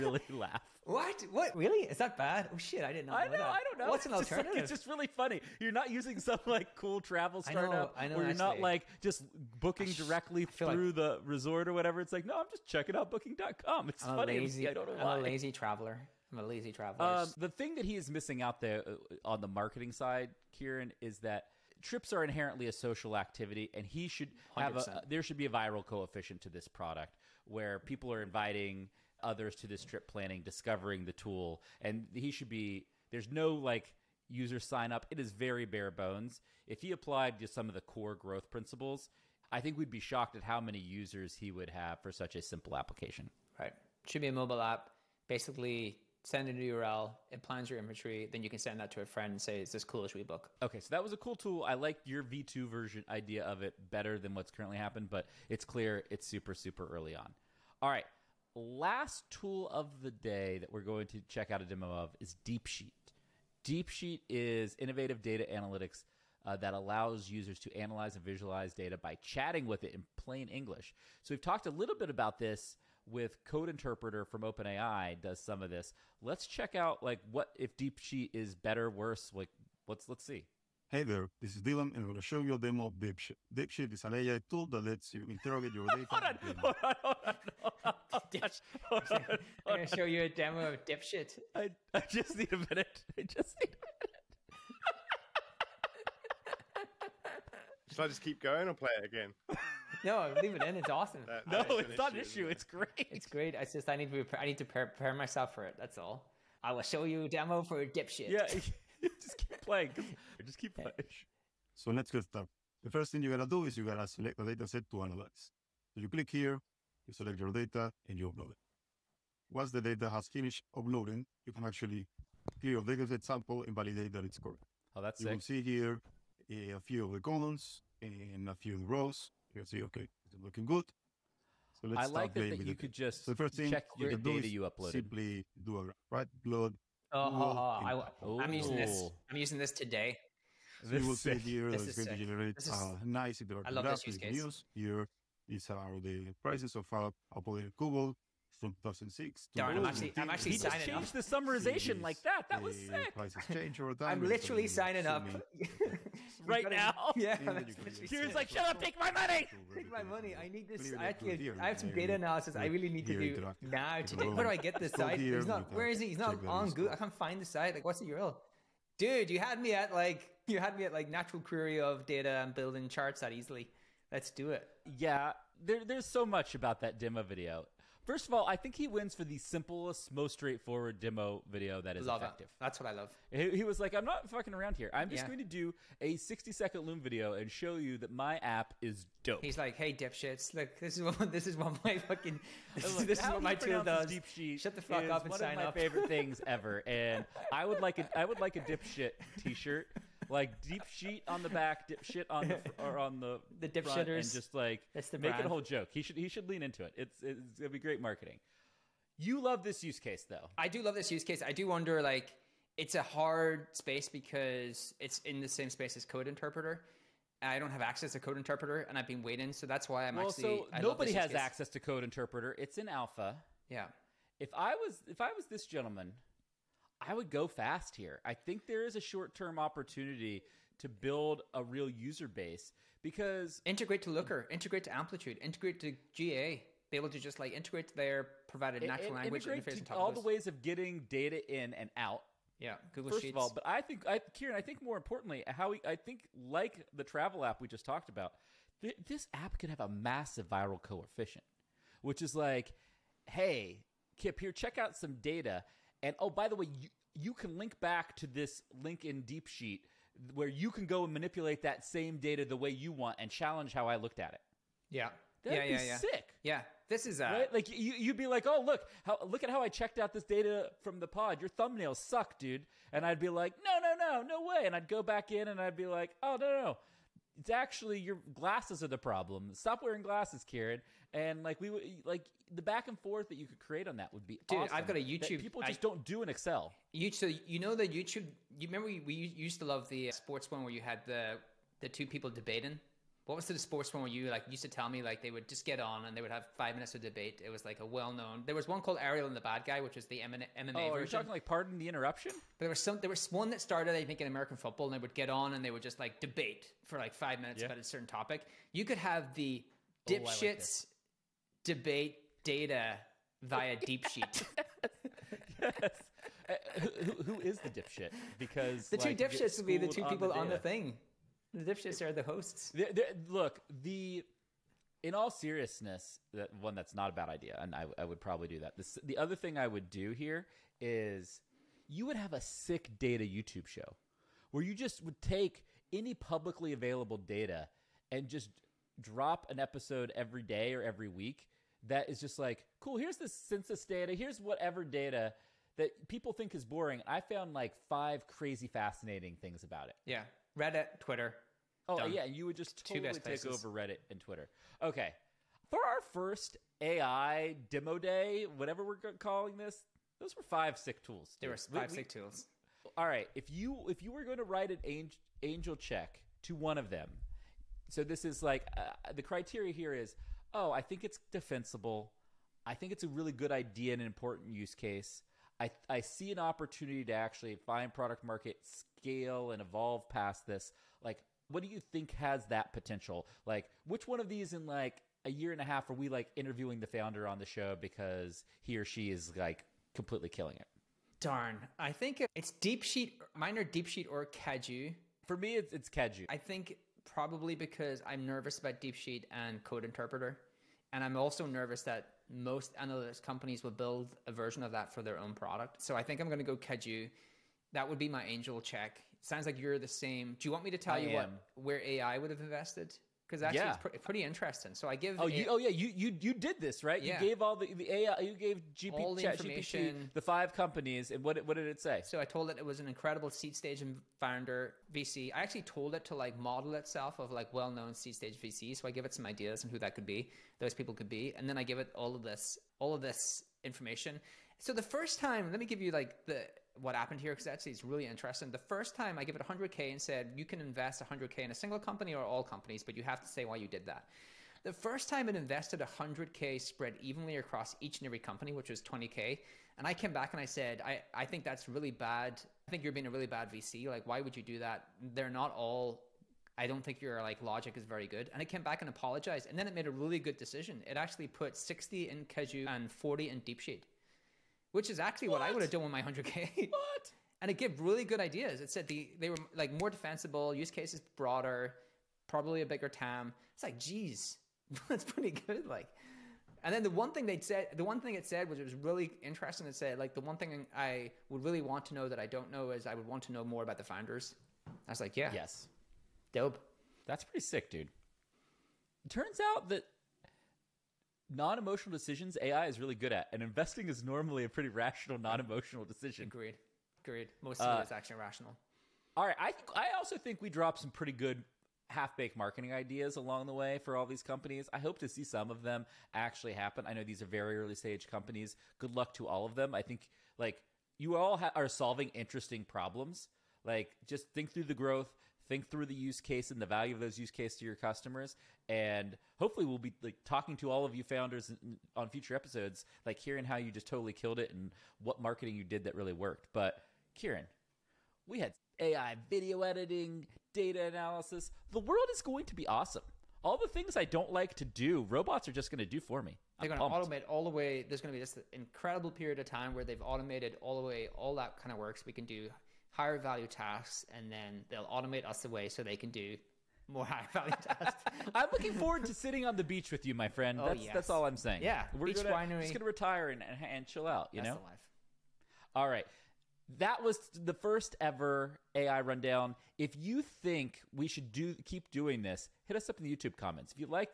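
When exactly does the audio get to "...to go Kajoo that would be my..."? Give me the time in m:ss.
6:46.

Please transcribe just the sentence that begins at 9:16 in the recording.
That was the first ever AI rundown.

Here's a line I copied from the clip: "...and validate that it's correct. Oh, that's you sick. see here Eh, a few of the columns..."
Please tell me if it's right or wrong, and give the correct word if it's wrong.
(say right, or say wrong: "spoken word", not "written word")
right.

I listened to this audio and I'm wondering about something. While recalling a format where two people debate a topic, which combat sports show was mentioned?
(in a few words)
Ariel and the Bad Guy.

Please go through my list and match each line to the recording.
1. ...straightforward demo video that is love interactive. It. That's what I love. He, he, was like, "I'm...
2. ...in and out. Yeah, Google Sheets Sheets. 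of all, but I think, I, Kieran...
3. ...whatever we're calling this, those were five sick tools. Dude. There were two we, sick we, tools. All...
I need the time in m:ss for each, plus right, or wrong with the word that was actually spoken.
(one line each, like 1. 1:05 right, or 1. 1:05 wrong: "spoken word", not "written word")
1. 3:00 wrong: "effective", not "interactive"
2. 4:01 wrong: "First", not "Sheets"
3. 5:58 wrong: "five", not "two".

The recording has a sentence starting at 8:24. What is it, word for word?
I hope to see some of them actually happen.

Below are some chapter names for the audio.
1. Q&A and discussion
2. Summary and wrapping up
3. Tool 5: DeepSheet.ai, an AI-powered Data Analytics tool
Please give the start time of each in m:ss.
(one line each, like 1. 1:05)
1. 6:03
2. 8:48
3. 0:58.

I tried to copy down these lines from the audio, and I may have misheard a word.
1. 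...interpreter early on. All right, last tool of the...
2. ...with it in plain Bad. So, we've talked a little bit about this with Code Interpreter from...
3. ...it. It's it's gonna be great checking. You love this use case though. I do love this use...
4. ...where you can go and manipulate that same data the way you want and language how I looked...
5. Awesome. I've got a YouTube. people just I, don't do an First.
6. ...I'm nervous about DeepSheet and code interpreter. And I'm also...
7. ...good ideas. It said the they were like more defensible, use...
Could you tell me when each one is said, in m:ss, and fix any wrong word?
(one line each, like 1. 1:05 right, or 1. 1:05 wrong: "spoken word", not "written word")
1. 0:56 wrong: "super", not "interpreter"
2. 1:09 wrong: "English", not "Bad"
3. 3:26 wrong: "marketing", not "checking"
4. 4:20 wrong: "challenge", not "language"
5. 4:44 wrong: "Excel", not "First"
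6. 6:38 right
7. 7:48 right.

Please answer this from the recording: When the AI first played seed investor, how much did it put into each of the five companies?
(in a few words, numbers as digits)
20K.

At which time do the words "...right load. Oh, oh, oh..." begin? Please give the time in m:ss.
2:16.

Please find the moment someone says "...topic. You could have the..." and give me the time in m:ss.
5:08.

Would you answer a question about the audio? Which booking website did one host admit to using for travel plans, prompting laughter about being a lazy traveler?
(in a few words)
booking.com.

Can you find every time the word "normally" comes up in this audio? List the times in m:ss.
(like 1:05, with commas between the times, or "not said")
8:14.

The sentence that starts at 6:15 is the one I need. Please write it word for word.
I, I see an opportunity to actually find product market scale and evolve past this.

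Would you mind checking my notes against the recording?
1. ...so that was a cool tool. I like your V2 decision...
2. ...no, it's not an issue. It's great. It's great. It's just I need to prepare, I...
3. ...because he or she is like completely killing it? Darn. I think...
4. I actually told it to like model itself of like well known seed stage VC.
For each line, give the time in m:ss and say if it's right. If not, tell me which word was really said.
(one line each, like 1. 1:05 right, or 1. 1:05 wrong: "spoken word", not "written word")
1. 0:50 wrong: "version", not "decision"
2. 1:41 right
3. 6:27 right
4. 7:05 right.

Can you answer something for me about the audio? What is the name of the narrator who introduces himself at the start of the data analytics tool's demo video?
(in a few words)
Dylan.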